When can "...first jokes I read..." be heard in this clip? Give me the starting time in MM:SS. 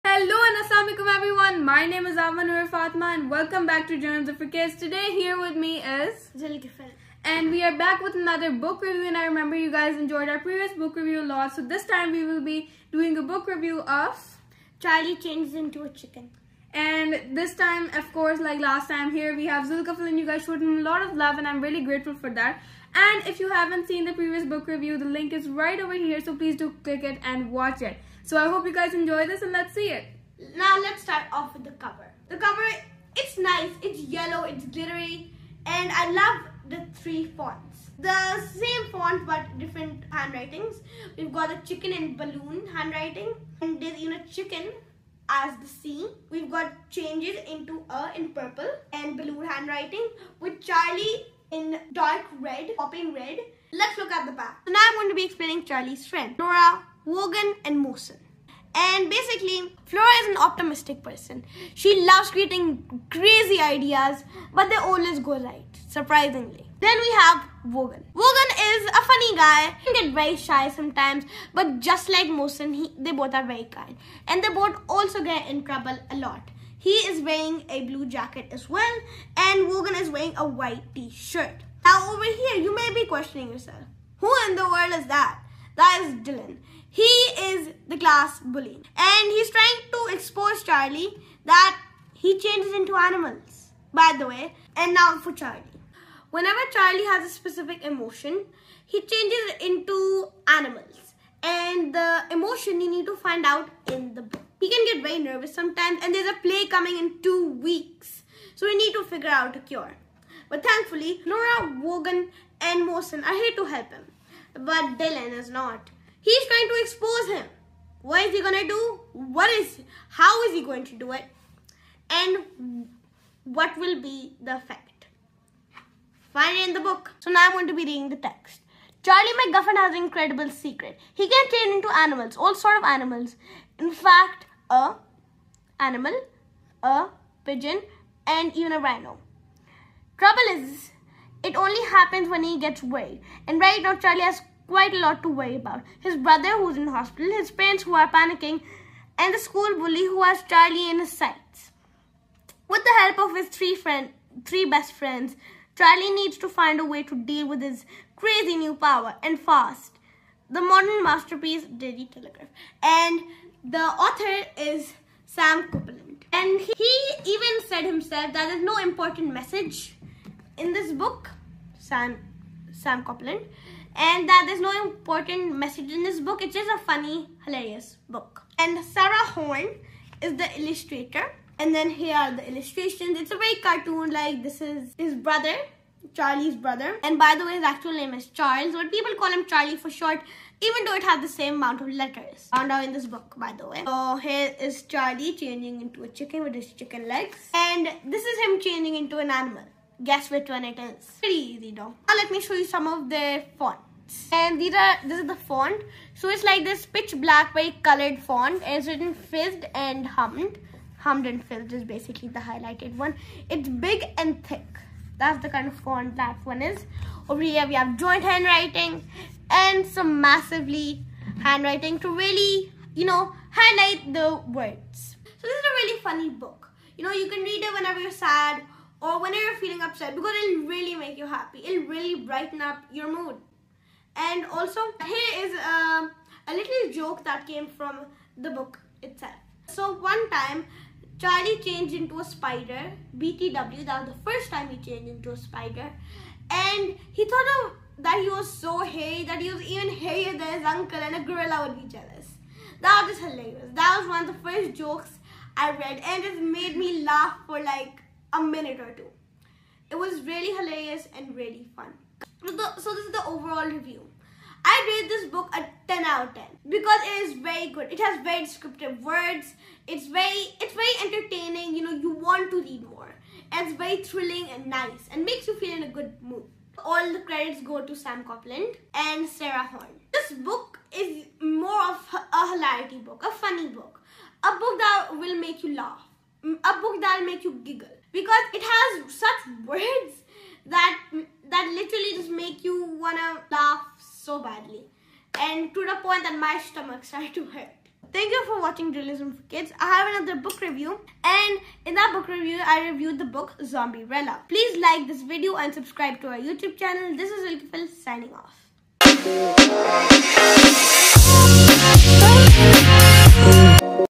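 04:14.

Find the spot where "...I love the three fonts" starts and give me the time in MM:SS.
00:35.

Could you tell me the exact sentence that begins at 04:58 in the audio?
Thank you for watching Journalism for Kids.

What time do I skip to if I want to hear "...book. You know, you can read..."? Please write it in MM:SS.
03:46.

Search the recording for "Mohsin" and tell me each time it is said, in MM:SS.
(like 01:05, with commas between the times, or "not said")
00:57, 01:12, 01:52.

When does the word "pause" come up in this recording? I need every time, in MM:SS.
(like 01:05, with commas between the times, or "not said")
not said.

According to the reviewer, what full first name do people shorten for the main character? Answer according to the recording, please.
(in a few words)
Charles.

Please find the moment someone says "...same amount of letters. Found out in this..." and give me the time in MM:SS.
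03:11.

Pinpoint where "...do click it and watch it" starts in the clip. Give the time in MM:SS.
00:26.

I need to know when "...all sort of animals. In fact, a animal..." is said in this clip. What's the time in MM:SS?
02:12.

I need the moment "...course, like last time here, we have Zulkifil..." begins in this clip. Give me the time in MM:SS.
00:18.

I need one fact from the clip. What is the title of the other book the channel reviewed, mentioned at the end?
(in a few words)
Zombierella.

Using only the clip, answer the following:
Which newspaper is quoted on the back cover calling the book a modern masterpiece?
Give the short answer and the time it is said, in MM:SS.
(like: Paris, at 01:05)
Daily Telegraph, at 02:41.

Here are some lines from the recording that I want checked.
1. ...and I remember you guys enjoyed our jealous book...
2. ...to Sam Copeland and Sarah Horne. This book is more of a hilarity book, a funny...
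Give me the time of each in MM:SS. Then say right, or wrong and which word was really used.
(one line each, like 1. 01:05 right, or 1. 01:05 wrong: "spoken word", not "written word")
1. 00:09 wrong: "previous", not "jealous"
2. 04:37 right.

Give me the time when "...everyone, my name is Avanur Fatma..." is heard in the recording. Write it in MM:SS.
00:01.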